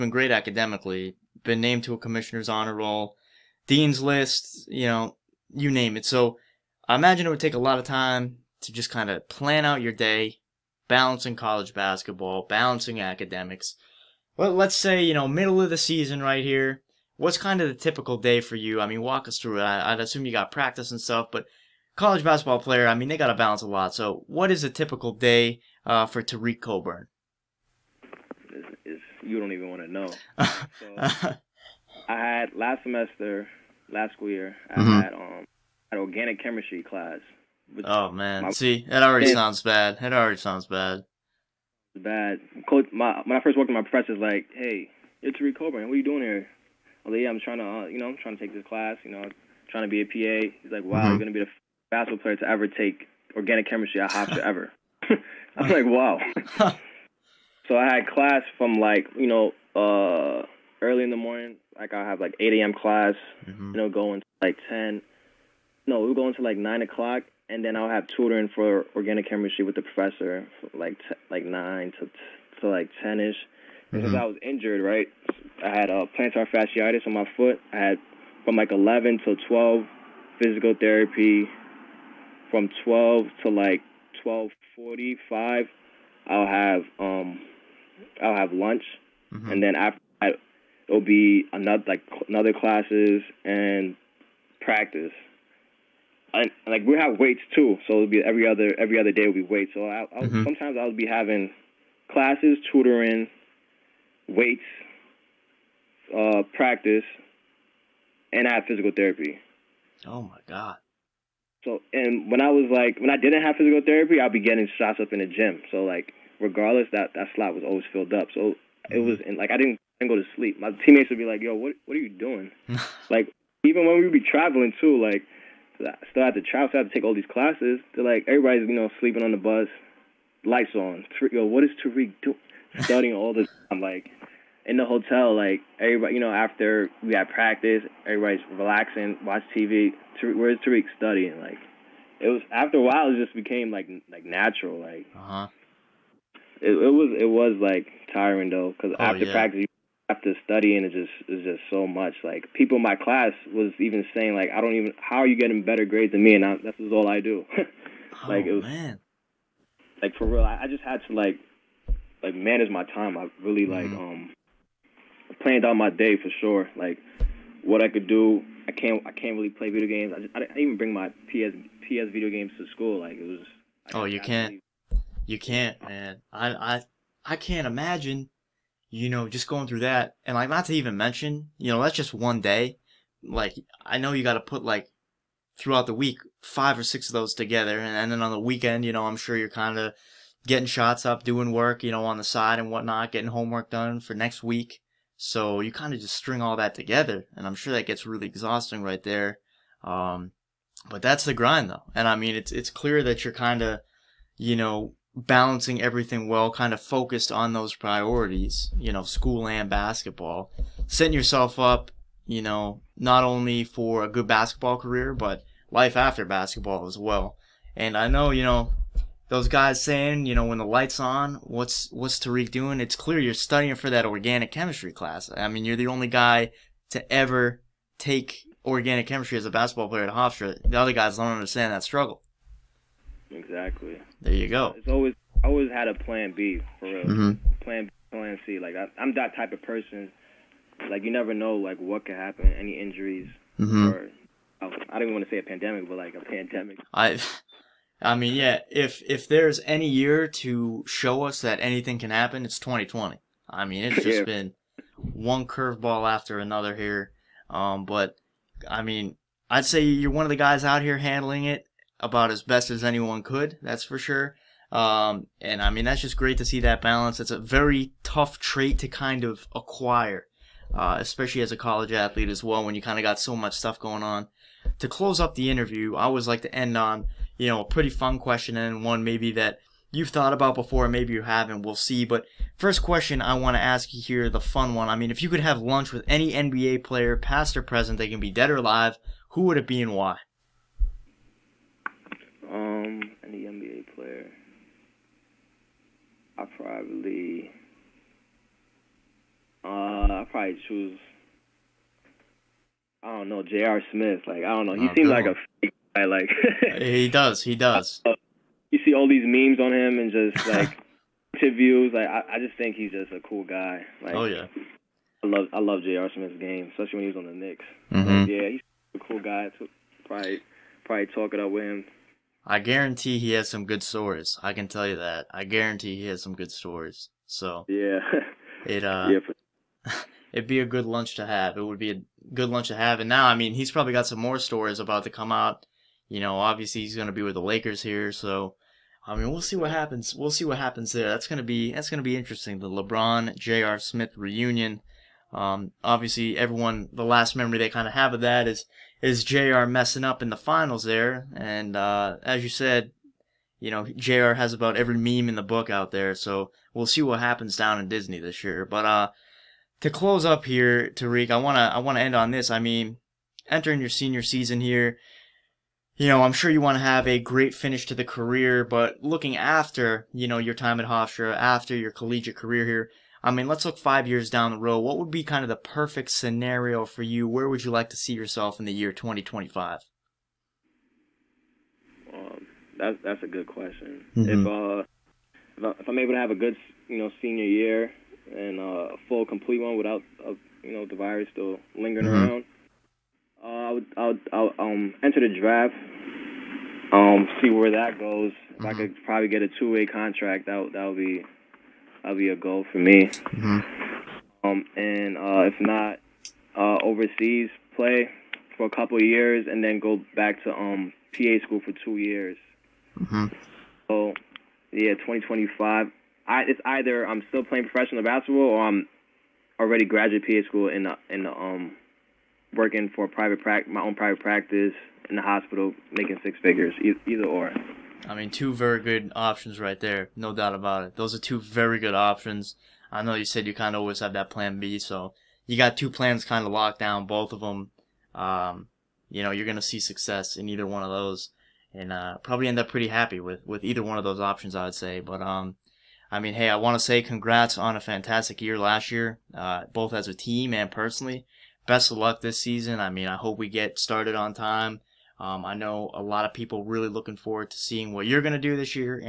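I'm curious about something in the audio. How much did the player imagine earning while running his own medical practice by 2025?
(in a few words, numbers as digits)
Six figures.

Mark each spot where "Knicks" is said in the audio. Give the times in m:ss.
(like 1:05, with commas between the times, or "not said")
5:17.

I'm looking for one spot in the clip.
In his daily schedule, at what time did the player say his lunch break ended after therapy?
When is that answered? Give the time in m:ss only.
1:24.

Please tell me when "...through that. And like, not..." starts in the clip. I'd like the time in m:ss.
2:59.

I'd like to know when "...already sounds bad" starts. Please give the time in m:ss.
0:40.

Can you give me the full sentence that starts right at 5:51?
And uh, as you said, you know, JR has about every meme in the book out there.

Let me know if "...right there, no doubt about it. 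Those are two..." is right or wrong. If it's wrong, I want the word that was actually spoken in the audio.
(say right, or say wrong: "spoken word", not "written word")
right.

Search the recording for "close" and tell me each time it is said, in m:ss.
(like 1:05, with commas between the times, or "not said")
4:34, 5:59.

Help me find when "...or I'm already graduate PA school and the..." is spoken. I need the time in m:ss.
6:58.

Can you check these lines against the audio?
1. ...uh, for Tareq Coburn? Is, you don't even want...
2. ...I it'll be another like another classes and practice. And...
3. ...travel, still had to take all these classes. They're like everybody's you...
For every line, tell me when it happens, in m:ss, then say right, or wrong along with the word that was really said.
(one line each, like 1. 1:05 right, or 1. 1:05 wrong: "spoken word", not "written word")
1. 0:25 right
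2. 1:30 right
3. 2:06 right.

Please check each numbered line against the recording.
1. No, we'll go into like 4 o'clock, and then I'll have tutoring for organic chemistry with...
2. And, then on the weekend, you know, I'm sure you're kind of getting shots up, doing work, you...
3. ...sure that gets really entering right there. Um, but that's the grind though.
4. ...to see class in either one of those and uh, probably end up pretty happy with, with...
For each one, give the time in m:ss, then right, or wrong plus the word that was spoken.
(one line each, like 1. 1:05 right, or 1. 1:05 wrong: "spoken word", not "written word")
1. 1:05 wrong: "9", not "4"
2. 3:07 right
3. 3:17 wrong: "exhausting", not "entering"
4. 7:19 wrong: "success", not "class".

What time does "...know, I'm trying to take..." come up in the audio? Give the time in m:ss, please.
0:47.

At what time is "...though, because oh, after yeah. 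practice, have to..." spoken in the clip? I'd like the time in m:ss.
2:28.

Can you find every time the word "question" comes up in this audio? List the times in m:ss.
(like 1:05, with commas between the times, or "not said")
4:38, 4:42, 6:23.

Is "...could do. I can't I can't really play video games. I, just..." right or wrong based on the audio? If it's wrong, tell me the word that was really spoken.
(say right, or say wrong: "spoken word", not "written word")
right.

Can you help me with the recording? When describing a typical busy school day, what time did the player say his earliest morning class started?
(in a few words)
8 a.m.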